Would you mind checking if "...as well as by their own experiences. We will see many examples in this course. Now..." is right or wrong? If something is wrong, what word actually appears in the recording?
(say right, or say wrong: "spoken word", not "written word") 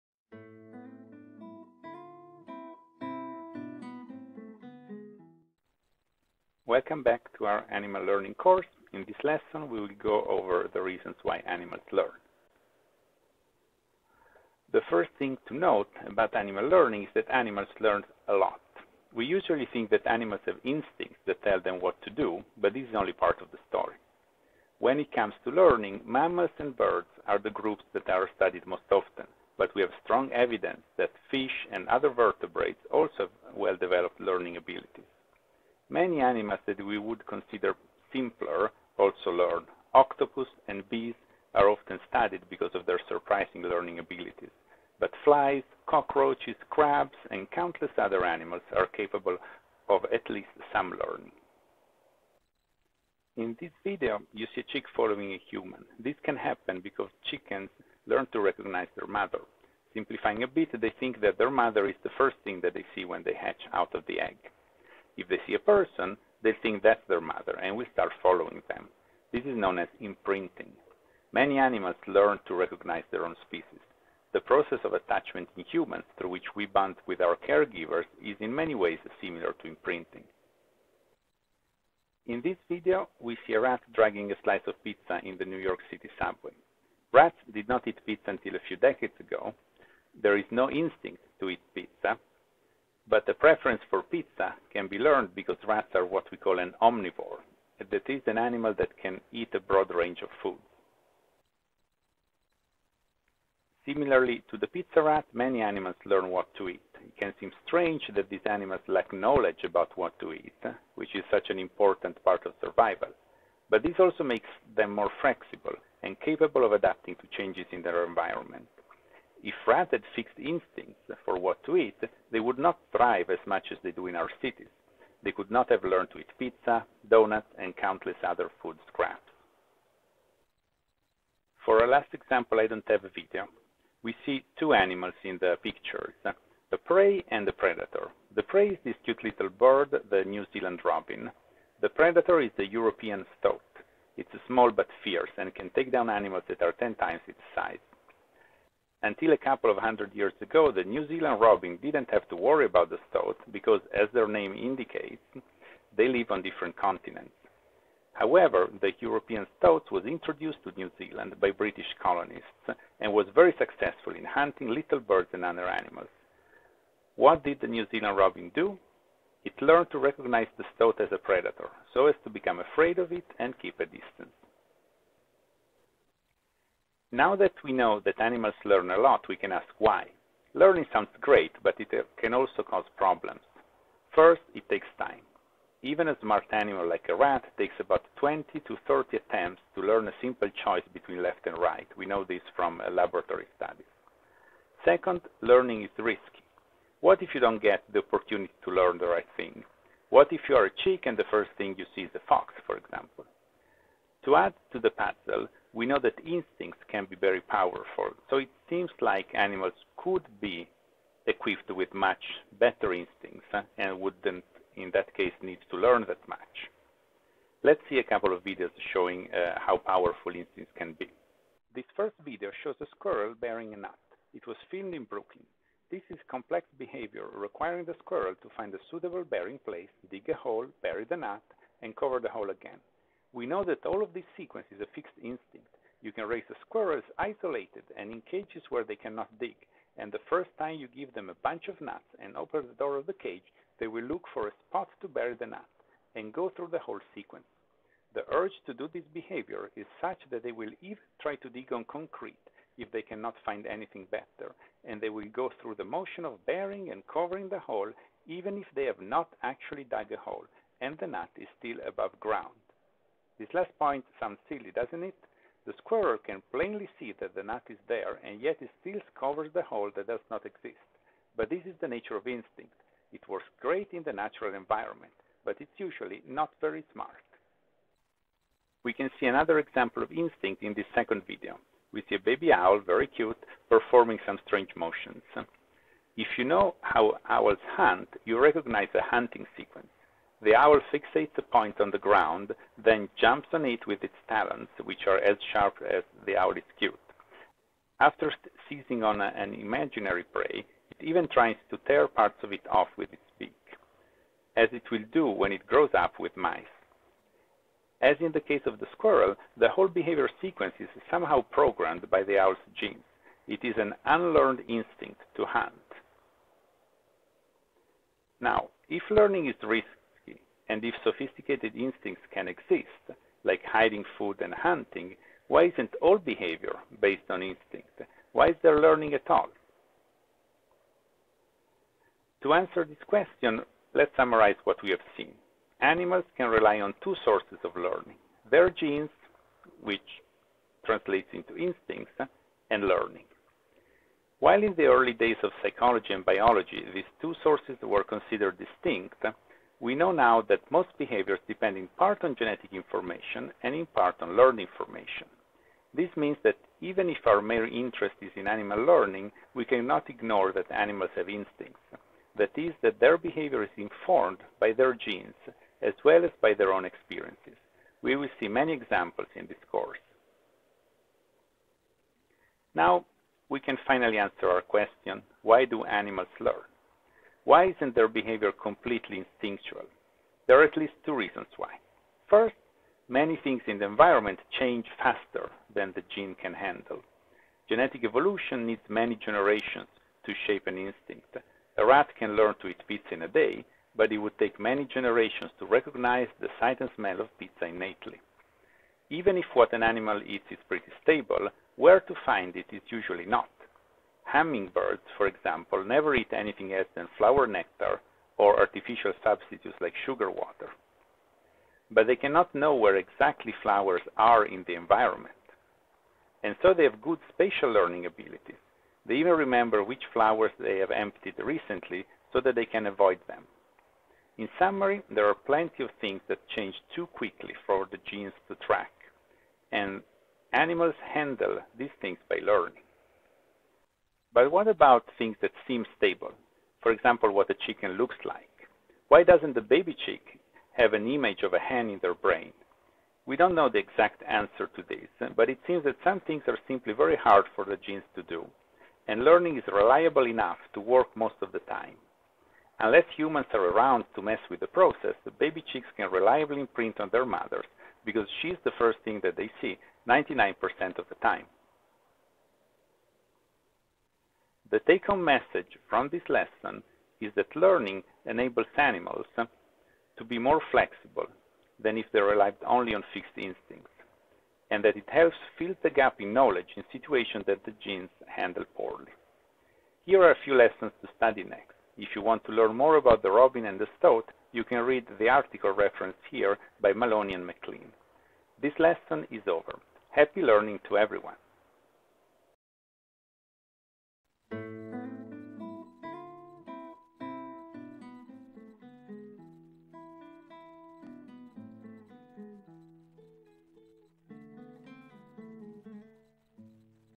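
right.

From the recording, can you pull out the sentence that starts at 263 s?
This last point sounds silly, doesn't it?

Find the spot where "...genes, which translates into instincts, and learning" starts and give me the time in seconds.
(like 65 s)
338 s.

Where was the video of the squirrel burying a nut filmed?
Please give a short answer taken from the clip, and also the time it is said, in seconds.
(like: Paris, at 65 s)
Brooklyn, at 225 s.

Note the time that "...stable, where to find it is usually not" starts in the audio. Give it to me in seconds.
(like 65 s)
401 s.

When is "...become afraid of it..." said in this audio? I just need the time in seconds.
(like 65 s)
172 s.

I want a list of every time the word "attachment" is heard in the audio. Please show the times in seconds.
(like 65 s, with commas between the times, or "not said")
74 s.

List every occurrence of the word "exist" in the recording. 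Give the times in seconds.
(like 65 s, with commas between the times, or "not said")
270 s, 322 s.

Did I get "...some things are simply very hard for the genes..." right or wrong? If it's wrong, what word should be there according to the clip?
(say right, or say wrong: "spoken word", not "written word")
right.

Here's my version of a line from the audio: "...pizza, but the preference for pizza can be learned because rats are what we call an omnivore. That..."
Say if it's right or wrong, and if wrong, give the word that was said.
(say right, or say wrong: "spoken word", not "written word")
right.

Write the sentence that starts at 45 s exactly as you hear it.
But flies, cockroaches, crabs, and countless other animals are capable of at least some learning.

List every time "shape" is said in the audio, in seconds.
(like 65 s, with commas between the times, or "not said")
390 s.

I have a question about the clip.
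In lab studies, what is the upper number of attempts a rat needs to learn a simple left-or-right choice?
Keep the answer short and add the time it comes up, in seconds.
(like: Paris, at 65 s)
30, at 188 s.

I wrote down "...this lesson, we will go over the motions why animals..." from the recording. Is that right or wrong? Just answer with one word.
wrong.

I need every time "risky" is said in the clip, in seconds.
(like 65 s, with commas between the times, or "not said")
195 s, 319 s.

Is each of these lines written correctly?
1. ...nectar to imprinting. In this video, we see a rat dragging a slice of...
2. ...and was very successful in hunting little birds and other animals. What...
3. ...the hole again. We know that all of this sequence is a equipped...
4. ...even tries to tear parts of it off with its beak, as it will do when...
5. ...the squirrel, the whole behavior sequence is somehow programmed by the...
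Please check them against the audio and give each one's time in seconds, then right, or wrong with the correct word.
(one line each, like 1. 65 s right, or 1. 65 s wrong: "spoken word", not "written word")
1. 79 s wrong: "similar", not "nectar"
2. 162 s right
3. 232 s wrong: "fixed", not "equipped"
4. 300 s right
5. 308 s right.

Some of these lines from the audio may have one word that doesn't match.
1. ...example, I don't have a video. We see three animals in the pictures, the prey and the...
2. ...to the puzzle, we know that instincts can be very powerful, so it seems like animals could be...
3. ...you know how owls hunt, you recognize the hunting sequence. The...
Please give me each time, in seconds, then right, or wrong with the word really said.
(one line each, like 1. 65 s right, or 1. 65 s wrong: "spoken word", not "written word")
1. 132 s wrong: "two", not "three"
2. 204 s right
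3. 286 s right.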